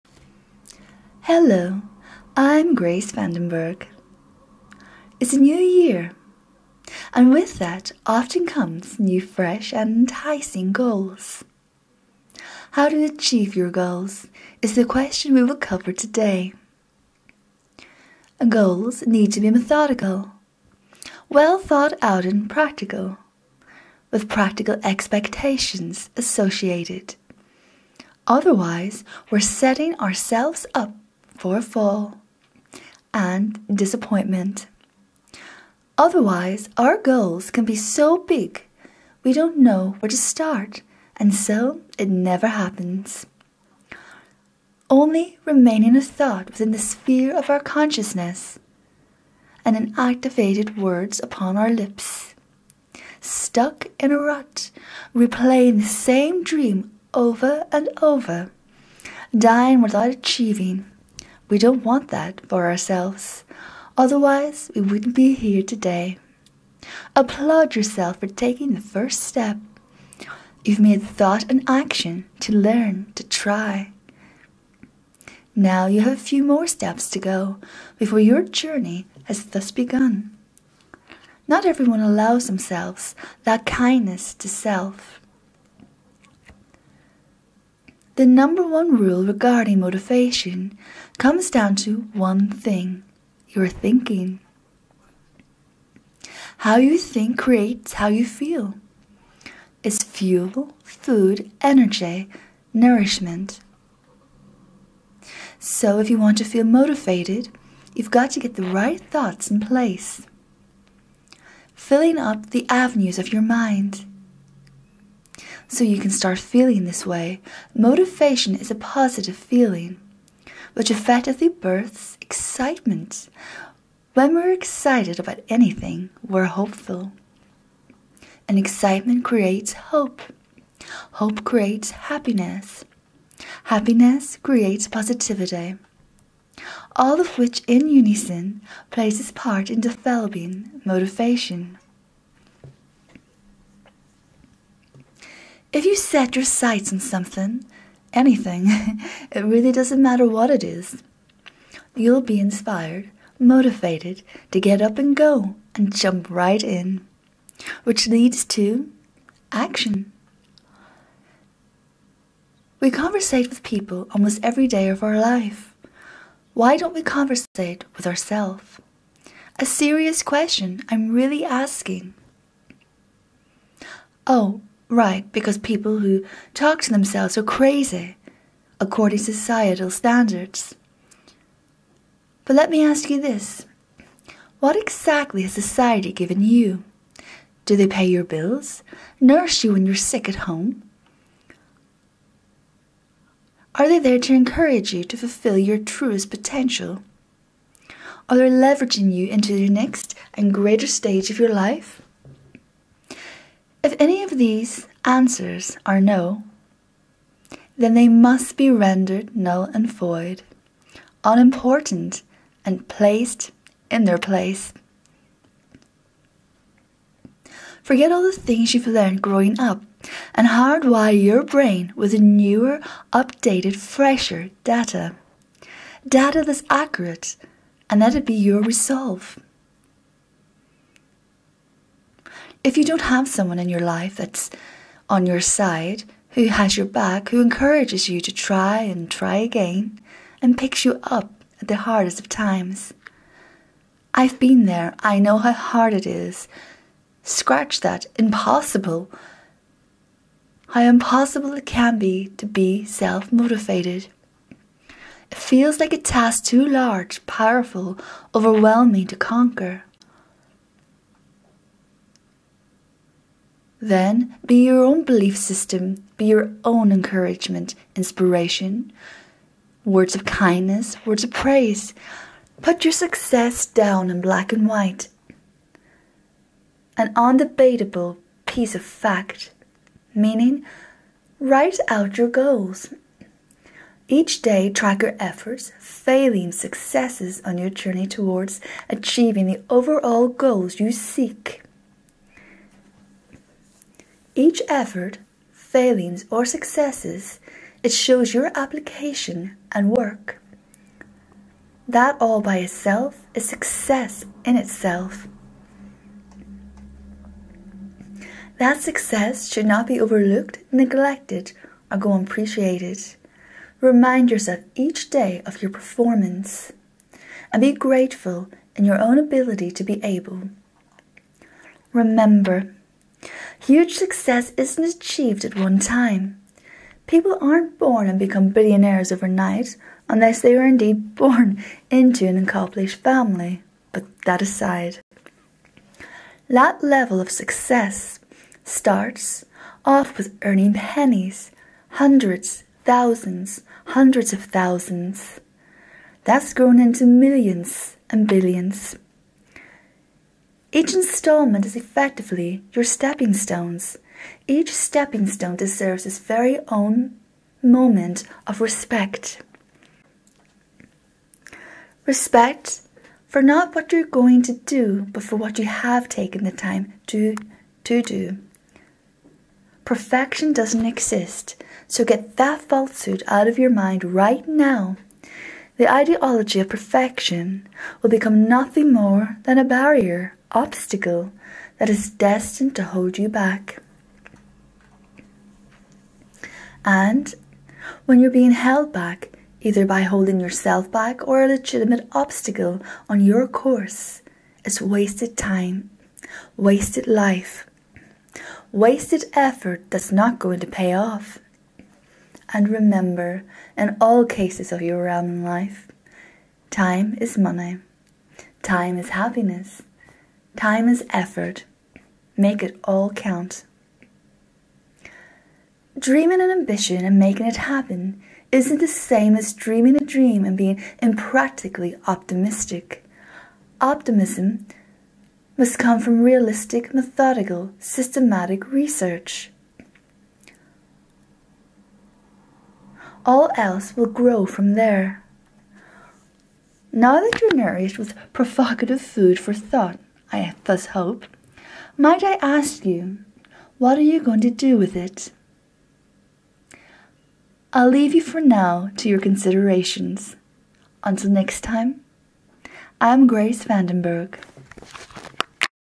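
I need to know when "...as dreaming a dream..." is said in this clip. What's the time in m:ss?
6:59.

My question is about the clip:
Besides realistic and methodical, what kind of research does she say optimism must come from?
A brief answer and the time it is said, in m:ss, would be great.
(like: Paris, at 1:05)
Systematic research, at 7:07.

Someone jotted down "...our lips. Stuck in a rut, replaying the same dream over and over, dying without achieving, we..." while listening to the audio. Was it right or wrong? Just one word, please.
right.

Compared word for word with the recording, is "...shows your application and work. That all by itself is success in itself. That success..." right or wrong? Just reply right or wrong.
right.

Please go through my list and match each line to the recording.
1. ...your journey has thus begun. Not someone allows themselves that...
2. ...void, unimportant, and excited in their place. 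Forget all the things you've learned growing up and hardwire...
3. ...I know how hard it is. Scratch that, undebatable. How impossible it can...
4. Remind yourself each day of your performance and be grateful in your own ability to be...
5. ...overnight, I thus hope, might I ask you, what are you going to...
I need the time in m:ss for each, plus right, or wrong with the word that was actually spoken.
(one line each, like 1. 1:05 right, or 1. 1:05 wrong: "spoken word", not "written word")
1. 1:18 wrong: "everyone", not "someone"
2. 3:29 wrong: "placed", not "excited"
3. 4:04 wrong: "impossible", not "undebatable"
4. 5:13 right
5. 7:19 wrong: "thought", not "overnight".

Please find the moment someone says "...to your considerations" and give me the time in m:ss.
7:28.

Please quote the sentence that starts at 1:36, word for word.
How you think creates how you feel.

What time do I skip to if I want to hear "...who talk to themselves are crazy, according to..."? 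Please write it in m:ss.
2:55.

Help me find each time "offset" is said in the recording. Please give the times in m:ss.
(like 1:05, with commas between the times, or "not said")
not said.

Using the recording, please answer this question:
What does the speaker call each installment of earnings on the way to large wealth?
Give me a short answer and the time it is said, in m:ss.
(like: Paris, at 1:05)
Stepping stones, at 5:52.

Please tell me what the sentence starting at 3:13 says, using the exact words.
Are they there to encourage you to fulfill your truest potential?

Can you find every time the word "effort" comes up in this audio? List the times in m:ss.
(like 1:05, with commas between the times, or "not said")
4:45, 4:54, 6:39, 6:51.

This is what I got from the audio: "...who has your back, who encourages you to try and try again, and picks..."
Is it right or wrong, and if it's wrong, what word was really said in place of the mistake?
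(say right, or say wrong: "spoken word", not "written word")
right.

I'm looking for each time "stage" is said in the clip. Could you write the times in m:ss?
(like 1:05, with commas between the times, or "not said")
3:20.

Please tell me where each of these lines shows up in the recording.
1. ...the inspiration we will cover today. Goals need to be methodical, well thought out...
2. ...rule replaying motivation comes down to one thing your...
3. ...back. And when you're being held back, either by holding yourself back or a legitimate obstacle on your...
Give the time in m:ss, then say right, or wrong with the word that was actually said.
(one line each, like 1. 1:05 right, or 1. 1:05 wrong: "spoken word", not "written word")
1. 0:14 wrong: "question", not "inspiration"
2. 1:28 wrong: "regarding", not "replaying"
3. 6:23 right.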